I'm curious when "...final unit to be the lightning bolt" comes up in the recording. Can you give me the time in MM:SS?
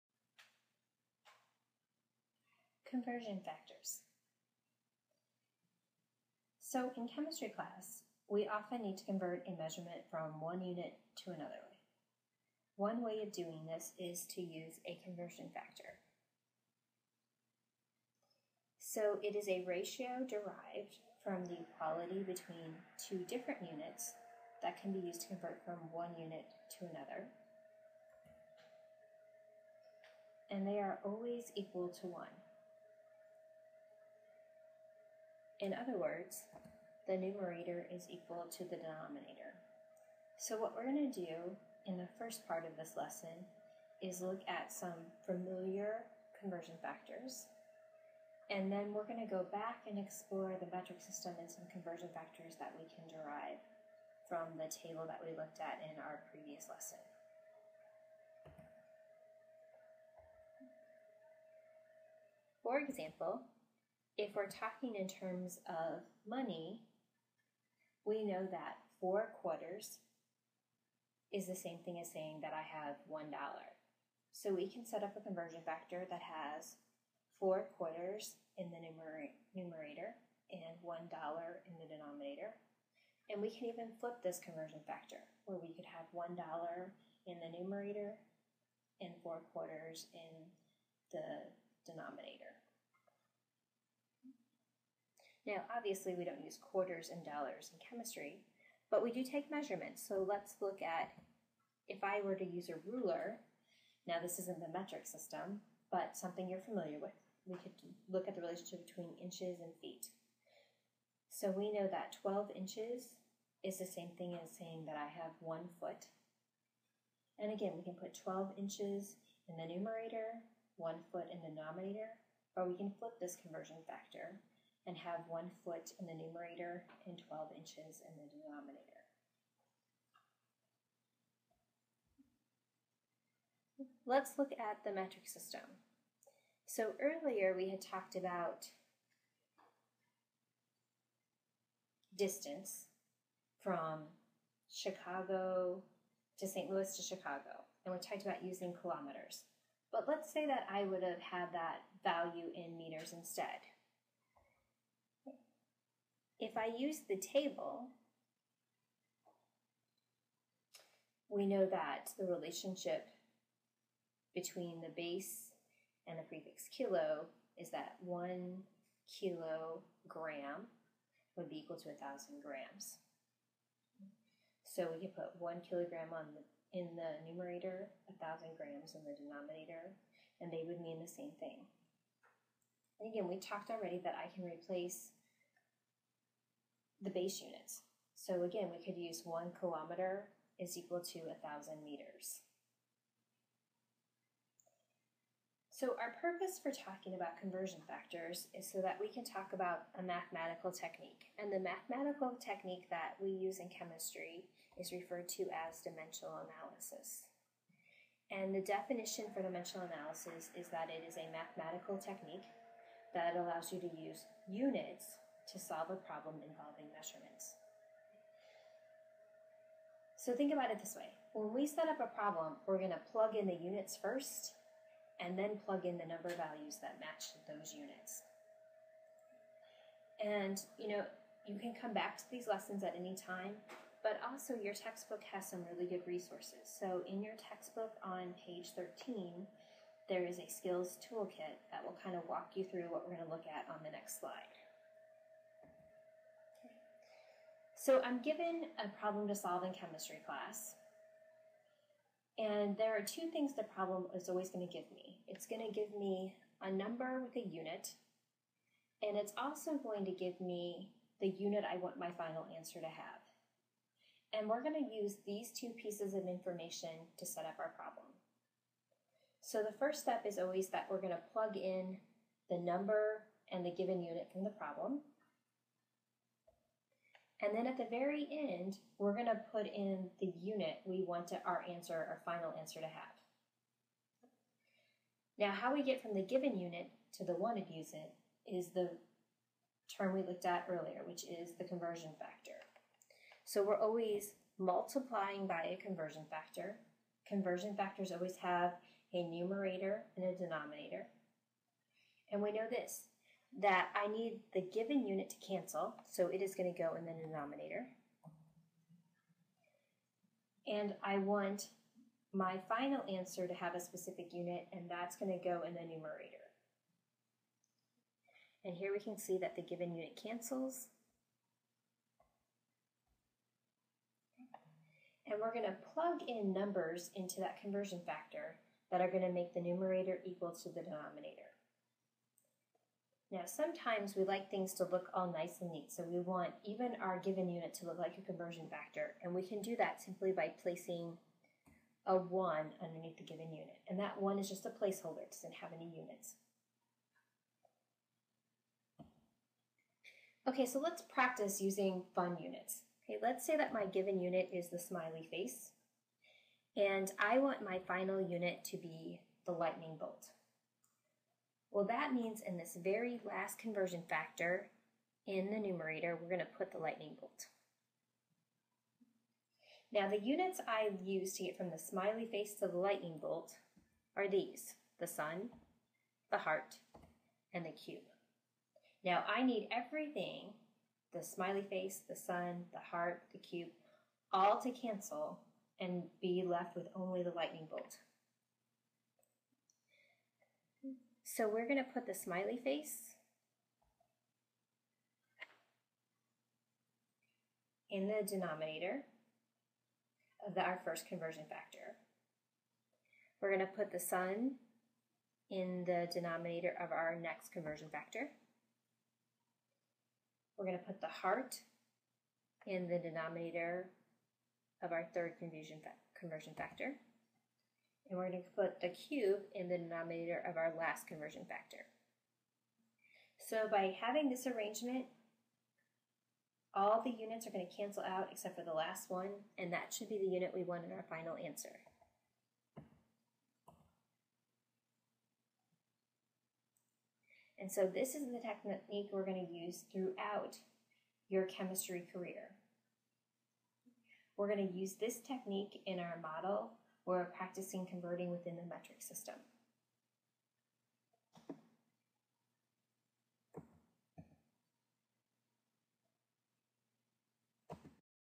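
05:57.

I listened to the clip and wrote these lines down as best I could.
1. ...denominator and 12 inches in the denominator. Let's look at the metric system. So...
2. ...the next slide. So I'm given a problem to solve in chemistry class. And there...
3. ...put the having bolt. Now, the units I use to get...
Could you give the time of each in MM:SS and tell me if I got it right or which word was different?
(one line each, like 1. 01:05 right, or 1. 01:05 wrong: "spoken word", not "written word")
1. 02:06 wrong: "numerator", not "denominator"
2. 04:03 right
3. 06:06 wrong: "lightning", not "having".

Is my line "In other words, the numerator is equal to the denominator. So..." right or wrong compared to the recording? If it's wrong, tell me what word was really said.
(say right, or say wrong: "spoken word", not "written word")
right.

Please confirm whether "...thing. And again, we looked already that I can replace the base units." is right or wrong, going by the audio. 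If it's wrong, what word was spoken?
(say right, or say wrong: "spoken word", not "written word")
wrong: "talked", not "looked".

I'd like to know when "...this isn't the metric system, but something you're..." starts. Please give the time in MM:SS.
01:44.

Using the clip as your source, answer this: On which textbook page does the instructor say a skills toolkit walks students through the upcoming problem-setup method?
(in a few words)
13.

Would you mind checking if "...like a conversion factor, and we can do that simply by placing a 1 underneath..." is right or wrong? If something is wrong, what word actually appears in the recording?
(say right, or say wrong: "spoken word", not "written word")
right.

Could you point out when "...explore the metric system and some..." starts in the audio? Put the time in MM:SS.
00:49.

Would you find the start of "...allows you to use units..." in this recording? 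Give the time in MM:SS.
03:33.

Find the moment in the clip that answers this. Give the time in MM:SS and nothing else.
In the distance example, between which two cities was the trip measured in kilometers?
02:24.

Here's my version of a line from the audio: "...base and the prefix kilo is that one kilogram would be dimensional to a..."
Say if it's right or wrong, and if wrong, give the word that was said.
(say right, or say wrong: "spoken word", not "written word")
wrong: "equal", not "dimensional".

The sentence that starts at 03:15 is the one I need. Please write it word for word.
So our purpose for talking about conversion factors is so that we can talk about a mathematical technique.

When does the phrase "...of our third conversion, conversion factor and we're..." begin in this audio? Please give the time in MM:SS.
06:54.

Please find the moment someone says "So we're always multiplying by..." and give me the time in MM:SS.
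04:53.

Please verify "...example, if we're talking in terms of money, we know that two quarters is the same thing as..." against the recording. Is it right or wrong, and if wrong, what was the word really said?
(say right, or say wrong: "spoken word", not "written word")
wrong: "four", not "two".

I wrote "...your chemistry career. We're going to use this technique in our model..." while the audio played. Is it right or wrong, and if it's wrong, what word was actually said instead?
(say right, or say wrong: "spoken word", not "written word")
right.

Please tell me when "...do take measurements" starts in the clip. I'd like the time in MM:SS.
01:39.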